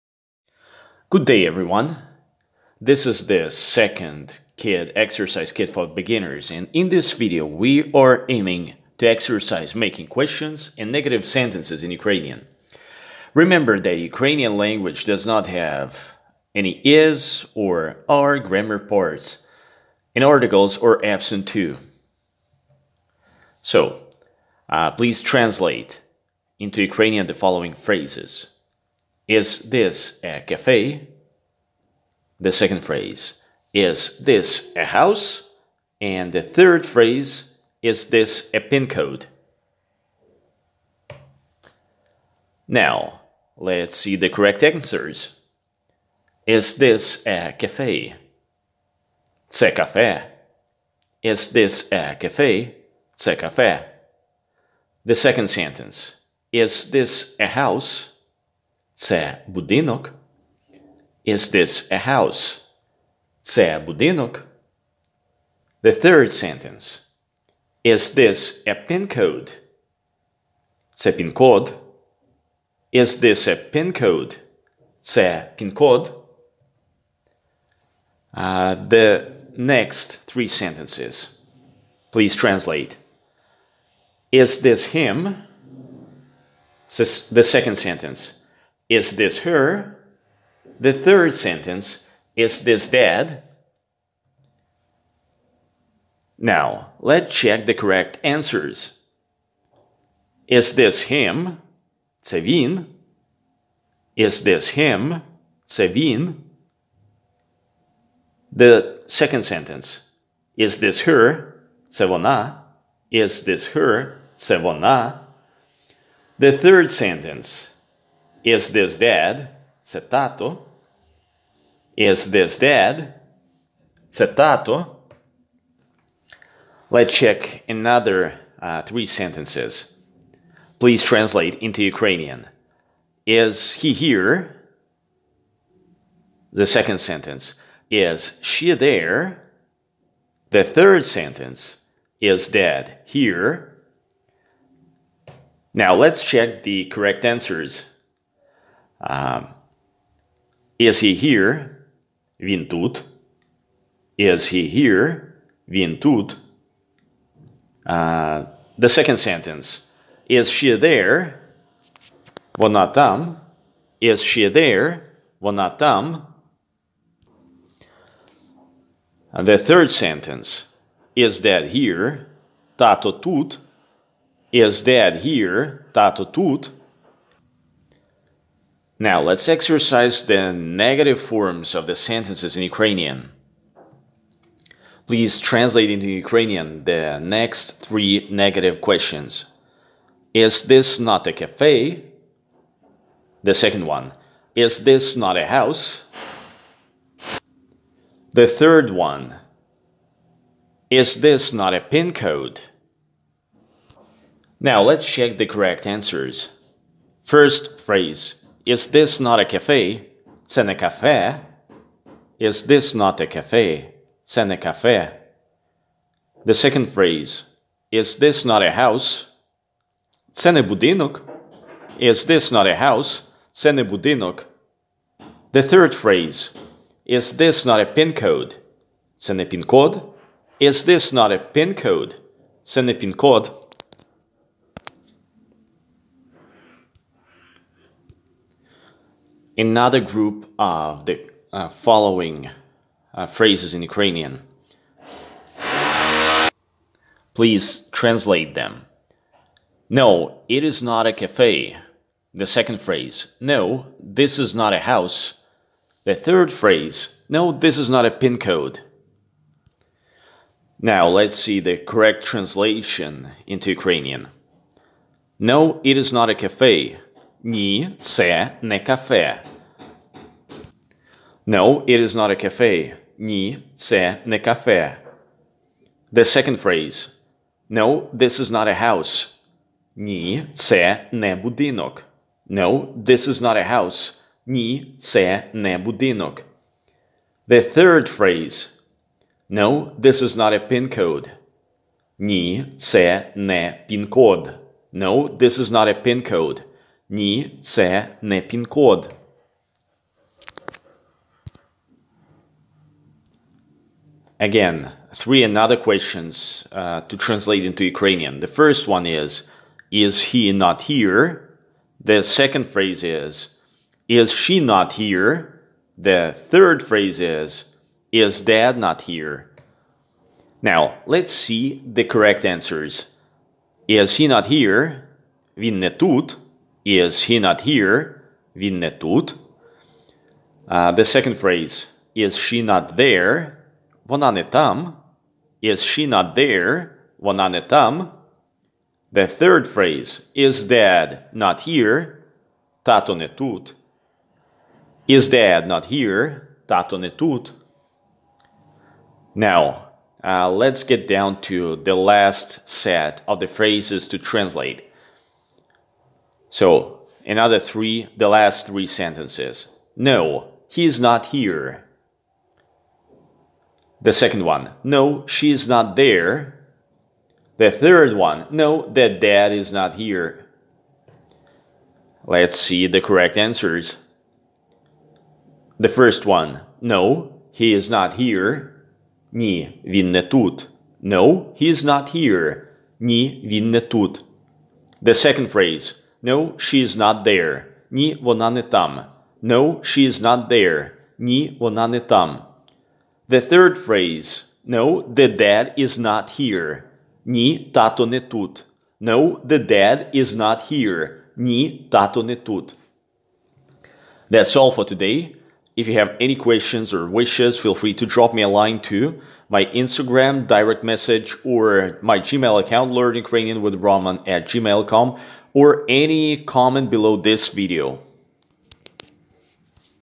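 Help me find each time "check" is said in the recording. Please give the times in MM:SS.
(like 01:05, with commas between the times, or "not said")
01:37, 02:07, 02:26, 03:25.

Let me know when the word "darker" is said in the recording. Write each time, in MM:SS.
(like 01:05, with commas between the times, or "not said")
not said.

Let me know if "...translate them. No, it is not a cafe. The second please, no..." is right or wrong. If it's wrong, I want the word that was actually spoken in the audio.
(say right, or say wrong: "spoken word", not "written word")
wrong: "phrase", not "please".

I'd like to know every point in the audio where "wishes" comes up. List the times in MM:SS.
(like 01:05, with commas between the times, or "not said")
06:47.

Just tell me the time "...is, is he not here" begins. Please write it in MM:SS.
05:09.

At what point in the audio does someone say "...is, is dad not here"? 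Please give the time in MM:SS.
05:17.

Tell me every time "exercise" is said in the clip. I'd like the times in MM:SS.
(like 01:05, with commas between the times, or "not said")
00:04, 00:09, 02:59.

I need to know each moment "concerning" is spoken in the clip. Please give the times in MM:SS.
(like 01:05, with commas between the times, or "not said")
not said.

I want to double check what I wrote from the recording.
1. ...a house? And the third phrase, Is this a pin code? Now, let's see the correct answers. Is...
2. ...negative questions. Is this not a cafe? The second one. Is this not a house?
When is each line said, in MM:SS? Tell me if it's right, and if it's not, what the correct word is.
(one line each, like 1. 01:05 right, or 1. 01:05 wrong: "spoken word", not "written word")
1. 00:34 right
2. 03:08 right.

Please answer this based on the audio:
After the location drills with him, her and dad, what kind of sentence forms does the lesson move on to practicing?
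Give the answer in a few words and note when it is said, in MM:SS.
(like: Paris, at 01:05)
negative forms, at 03:00.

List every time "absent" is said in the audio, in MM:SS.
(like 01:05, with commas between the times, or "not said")
00:21.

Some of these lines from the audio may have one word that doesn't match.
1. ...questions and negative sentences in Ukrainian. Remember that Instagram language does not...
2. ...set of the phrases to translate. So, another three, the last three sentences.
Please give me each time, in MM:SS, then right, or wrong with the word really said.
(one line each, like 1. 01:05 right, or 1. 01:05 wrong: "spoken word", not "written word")
1. 00:10 wrong: "Ukrainian", not "Instagram"
2. 05:52 right.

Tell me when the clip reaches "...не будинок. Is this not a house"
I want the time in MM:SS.
03:40.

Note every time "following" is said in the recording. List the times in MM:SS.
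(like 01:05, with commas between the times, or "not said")
00:27, 04:01.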